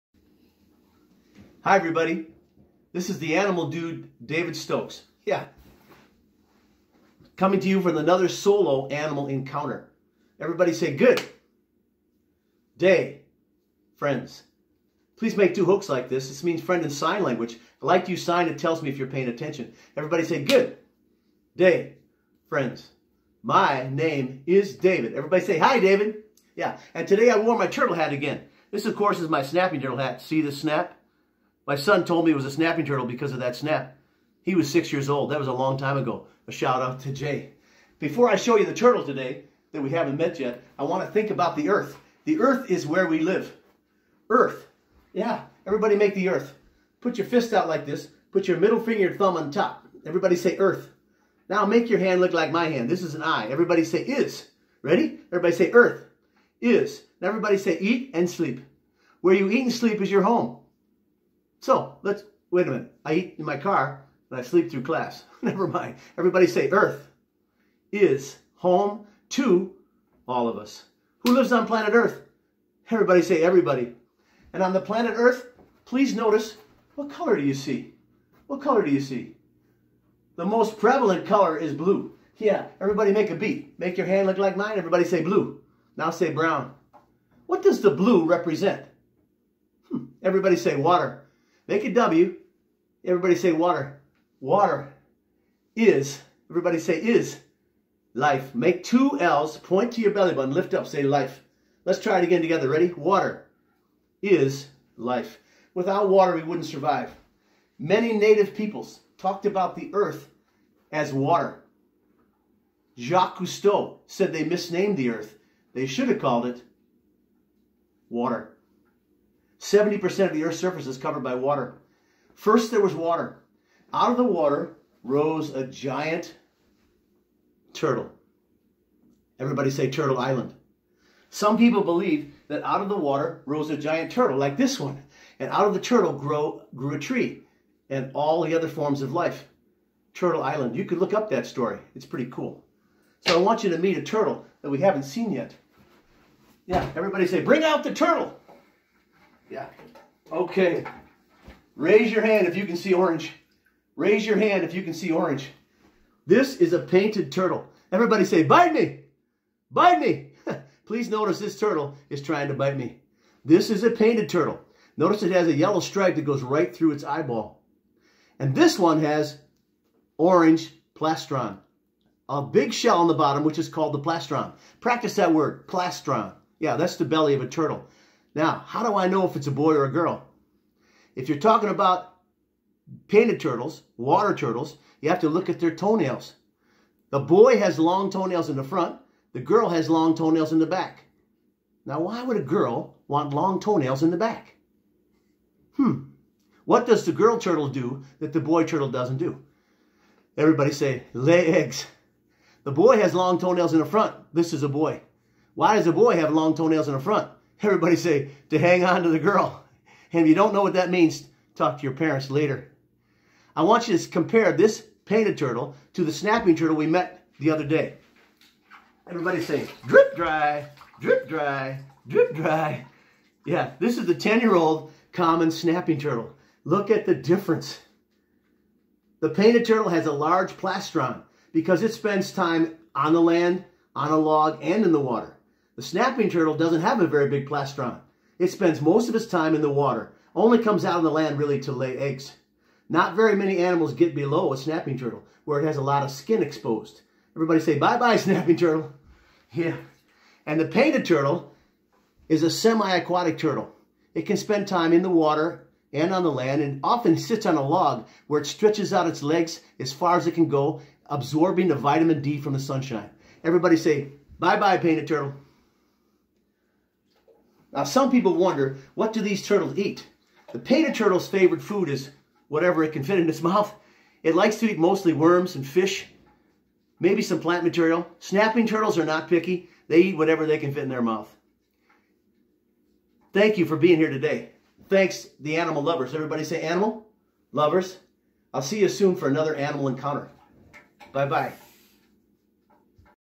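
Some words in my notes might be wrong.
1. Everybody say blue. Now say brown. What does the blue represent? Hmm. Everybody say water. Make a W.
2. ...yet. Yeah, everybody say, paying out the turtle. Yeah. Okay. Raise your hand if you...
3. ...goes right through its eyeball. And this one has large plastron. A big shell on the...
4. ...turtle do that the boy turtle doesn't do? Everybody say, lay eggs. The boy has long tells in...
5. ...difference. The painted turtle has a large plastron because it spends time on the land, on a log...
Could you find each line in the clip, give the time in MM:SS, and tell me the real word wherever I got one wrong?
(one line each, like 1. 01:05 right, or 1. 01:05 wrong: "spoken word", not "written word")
1. 01:24 right
2. 02:25 wrong: "bring", not "paying"
3. 02:46 wrong: "orange", not "large"
4. 03:17 wrong: "toenails", not "tells"
5. 03:47 right.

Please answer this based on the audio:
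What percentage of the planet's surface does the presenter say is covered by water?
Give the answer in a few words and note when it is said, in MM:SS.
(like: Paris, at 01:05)
70%, at 01:59.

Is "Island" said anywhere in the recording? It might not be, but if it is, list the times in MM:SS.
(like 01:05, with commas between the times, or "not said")
02:10, 02:20.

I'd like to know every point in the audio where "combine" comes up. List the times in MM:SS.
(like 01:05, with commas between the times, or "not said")
not said.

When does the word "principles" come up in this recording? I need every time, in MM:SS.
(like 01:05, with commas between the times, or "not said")
not said.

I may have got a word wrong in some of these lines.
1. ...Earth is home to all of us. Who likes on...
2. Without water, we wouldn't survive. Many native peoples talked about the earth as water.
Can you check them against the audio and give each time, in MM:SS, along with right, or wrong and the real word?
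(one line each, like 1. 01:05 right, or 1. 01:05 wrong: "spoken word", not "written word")
1. 01:06 wrong: "lives", not "likes"
2. 01:45 right.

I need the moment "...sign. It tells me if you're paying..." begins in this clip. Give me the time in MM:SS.
00:18.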